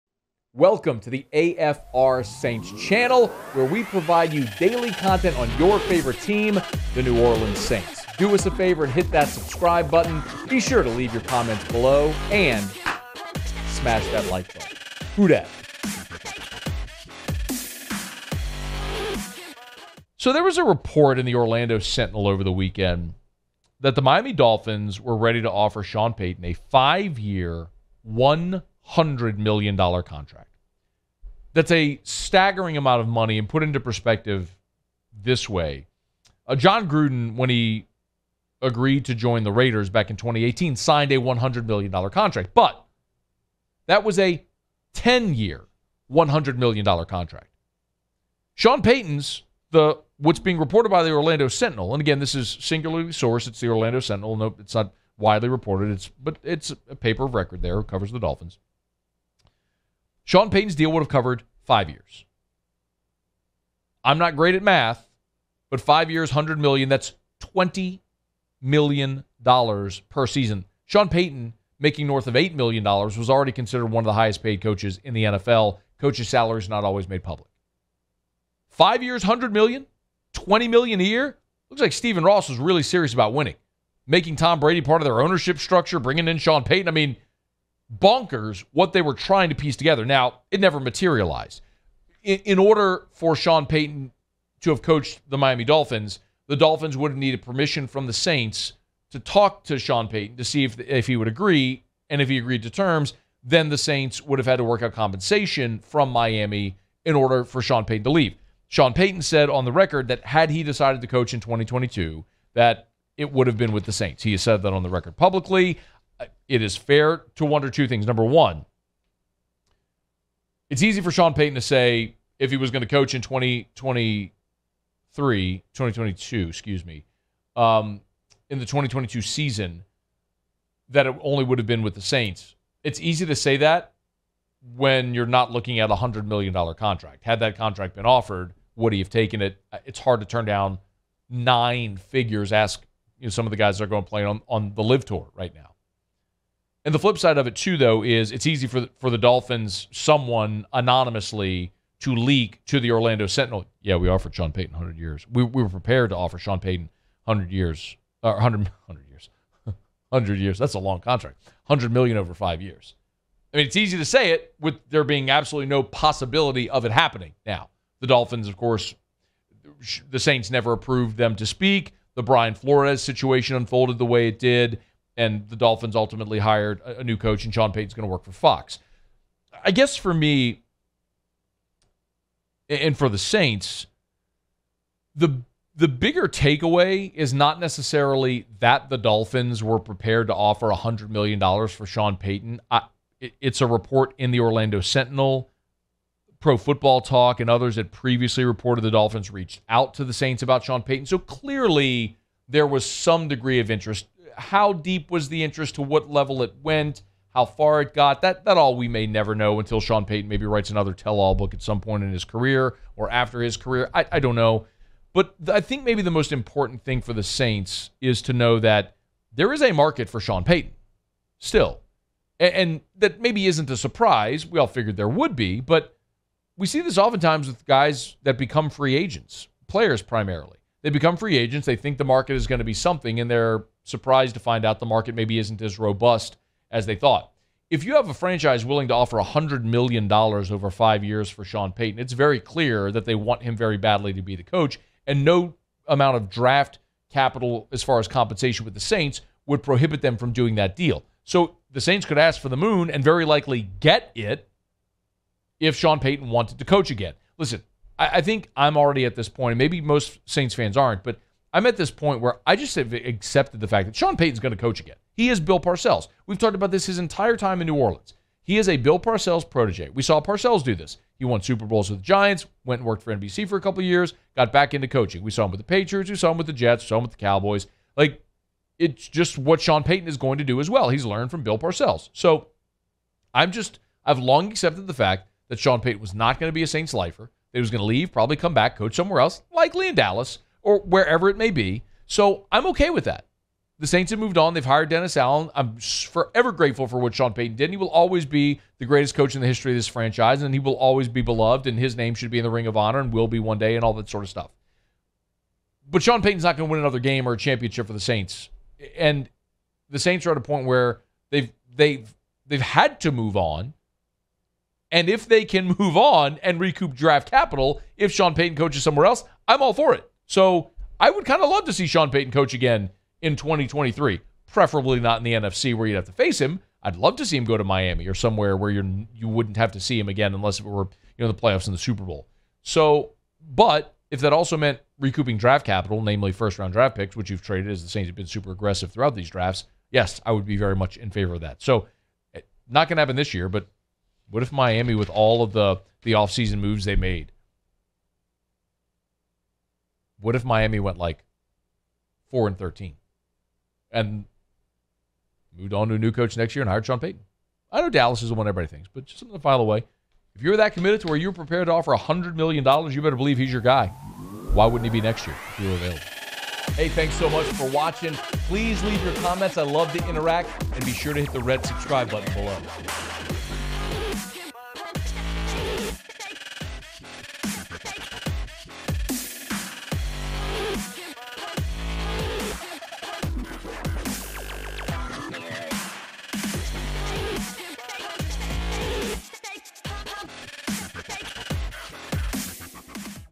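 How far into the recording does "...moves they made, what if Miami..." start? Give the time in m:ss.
5:46.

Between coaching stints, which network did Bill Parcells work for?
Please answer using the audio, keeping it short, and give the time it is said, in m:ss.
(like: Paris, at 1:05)
NBC, at 4:33.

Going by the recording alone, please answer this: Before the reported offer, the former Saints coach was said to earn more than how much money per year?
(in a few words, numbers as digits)
$8 million.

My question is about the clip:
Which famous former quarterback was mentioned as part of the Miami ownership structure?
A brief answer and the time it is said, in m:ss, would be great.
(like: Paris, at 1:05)
Tom Brady, at 1:24.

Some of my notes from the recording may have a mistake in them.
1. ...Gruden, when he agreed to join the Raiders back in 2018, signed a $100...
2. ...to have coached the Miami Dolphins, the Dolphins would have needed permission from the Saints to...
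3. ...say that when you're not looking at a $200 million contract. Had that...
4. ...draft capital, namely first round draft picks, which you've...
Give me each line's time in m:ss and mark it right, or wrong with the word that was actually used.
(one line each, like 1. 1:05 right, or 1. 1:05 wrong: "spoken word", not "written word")
1. 0:36 right
2. 1:34 right
3. 2:13 wrong: "100", not "200"
4. 5:35 right.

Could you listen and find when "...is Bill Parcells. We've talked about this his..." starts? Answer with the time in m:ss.
4:25.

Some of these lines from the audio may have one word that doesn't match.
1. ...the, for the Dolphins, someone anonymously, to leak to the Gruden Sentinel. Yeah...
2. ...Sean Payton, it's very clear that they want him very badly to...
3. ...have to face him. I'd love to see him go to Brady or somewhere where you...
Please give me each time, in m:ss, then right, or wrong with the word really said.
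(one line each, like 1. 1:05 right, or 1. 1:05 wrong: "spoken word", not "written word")
1. 2:28 wrong: "Orlando", not "Gruden"
2. 4:01 right
3. 5:25 wrong: "Miami", not "Brady".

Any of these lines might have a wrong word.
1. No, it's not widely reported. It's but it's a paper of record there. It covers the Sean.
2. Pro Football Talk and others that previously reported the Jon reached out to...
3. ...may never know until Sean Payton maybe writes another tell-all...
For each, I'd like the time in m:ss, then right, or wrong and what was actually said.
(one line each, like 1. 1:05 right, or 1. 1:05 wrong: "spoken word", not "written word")
1. 0:54 wrong: "Dolphins", not "Sean"
2. 3:16 wrong: "Dolphins", not "Jon"
3. 3:28 right.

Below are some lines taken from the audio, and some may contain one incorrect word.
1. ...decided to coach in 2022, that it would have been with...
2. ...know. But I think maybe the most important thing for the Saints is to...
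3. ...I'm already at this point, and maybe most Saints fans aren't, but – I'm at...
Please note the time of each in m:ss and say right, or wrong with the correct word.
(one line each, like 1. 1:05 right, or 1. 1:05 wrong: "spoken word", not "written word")
1. 1:50 right
2. 3:34 right
3. 4:18 right.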